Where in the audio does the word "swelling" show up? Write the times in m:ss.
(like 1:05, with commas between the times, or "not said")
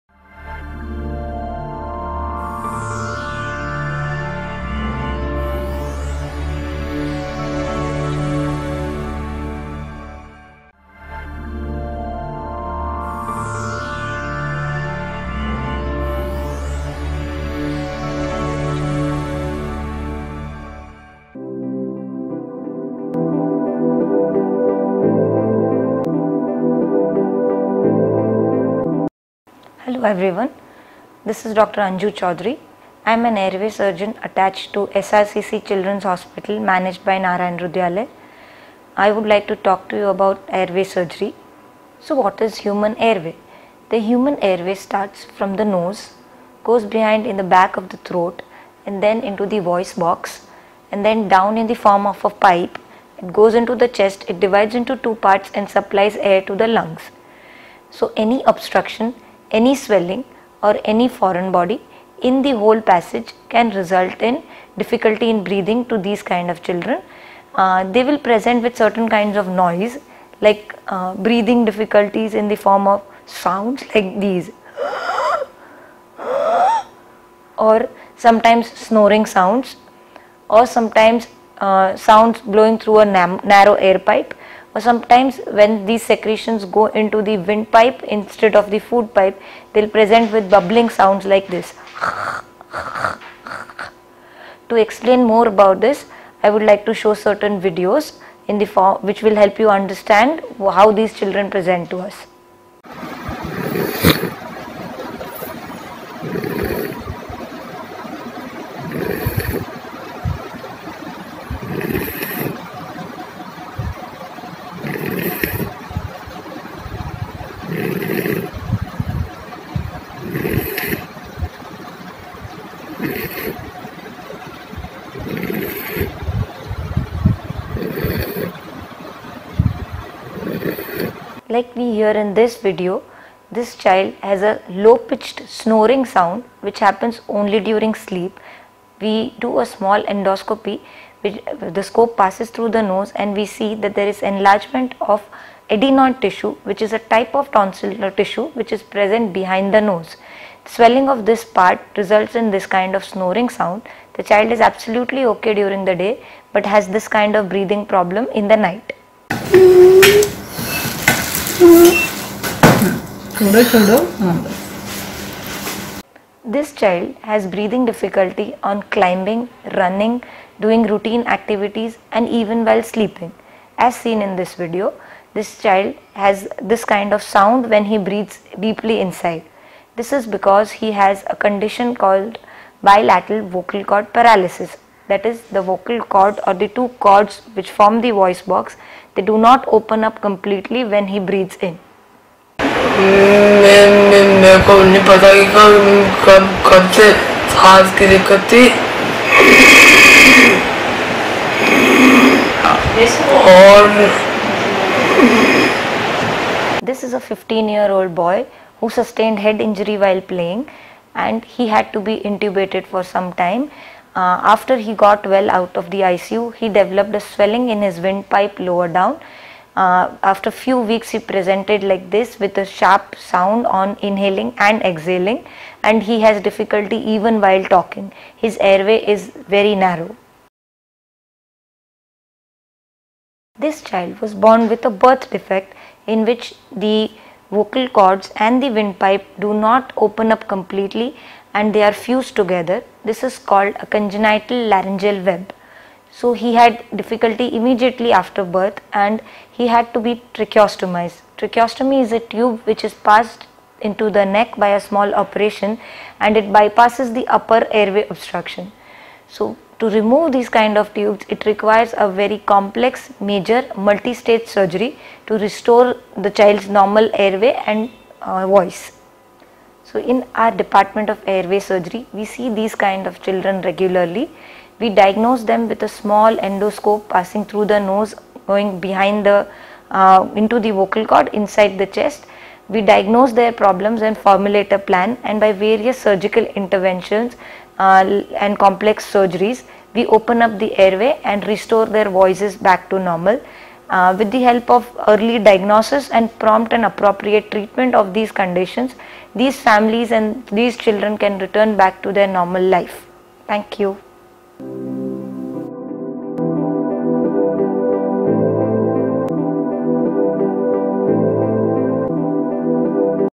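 0:59, 2:30, 3:37.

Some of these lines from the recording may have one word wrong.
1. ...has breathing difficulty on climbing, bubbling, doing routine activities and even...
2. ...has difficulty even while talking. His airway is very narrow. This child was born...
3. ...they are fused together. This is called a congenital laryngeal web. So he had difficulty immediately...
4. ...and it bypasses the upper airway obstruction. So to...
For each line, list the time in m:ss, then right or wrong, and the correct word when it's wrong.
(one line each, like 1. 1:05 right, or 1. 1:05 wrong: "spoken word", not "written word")
1. 2:47 wrong: "running", not "bubbling"
2. 3:46 right
3. 4:01 right
4. 4:16 right.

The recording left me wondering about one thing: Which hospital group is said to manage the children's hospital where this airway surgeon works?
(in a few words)
Narayana Hrudayalaya.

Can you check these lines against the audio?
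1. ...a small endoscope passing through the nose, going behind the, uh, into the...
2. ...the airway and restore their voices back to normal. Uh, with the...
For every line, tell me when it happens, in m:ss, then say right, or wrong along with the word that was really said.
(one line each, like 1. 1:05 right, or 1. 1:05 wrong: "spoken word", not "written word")
1. 4:35 right
2. 4:50 right.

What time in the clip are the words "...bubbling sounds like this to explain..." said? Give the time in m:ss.
1:30.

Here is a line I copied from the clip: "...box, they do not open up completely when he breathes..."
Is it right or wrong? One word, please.
right.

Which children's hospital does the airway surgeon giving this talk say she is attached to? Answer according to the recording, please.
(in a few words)
SRCC Children's Hospital.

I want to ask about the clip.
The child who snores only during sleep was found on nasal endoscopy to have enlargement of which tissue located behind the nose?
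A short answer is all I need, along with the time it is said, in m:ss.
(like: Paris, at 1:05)
Adenoid tissue, at 2:25.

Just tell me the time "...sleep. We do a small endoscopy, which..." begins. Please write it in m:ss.
2:17.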